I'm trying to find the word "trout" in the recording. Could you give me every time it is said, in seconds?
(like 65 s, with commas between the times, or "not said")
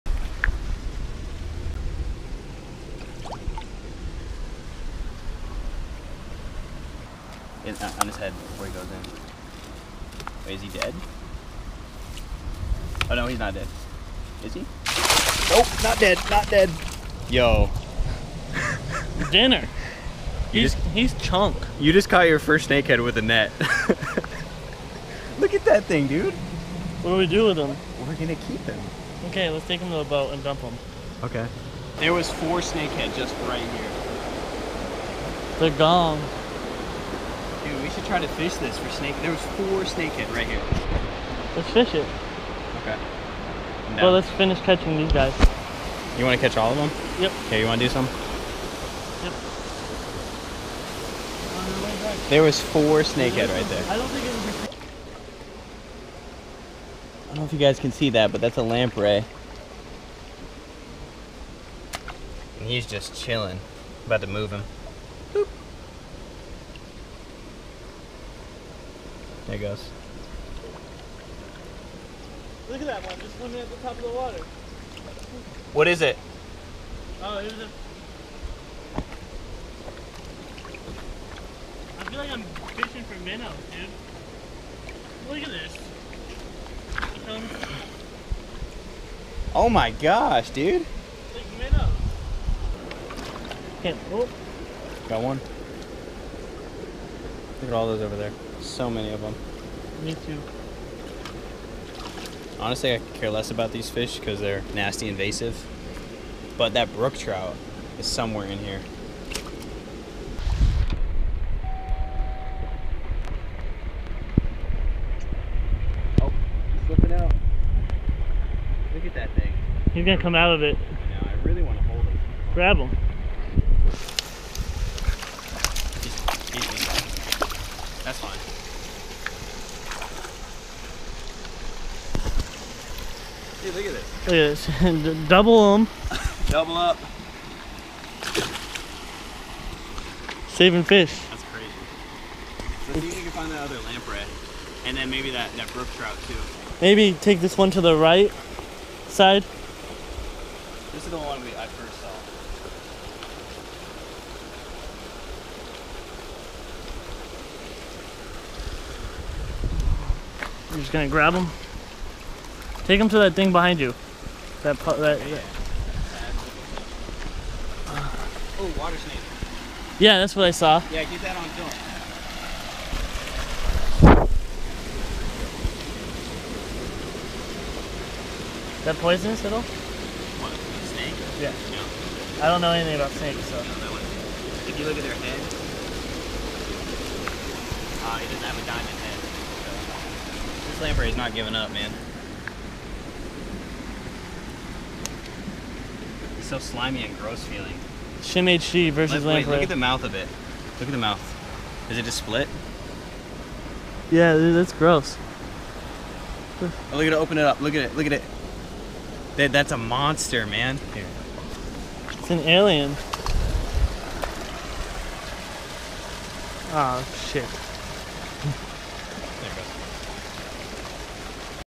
107 s, 145 s.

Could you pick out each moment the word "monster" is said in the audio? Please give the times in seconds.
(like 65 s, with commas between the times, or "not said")
209 s.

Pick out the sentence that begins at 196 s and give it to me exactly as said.
It's so slimy and gross feeling.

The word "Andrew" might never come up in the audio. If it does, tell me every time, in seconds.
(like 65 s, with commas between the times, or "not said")
not said.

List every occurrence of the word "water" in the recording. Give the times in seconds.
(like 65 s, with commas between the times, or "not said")
74 s, 168 s.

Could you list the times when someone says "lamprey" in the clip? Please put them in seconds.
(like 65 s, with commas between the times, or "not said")
58 s, 143 s, 199 s.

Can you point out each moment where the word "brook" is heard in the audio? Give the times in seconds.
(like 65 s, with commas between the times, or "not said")
106 s, 145 s.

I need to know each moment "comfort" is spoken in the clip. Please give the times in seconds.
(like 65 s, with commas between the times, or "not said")
not said.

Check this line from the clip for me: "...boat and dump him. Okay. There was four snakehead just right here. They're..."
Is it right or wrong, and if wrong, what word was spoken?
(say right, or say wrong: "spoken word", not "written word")
right.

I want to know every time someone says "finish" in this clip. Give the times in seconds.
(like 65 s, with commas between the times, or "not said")
44 s.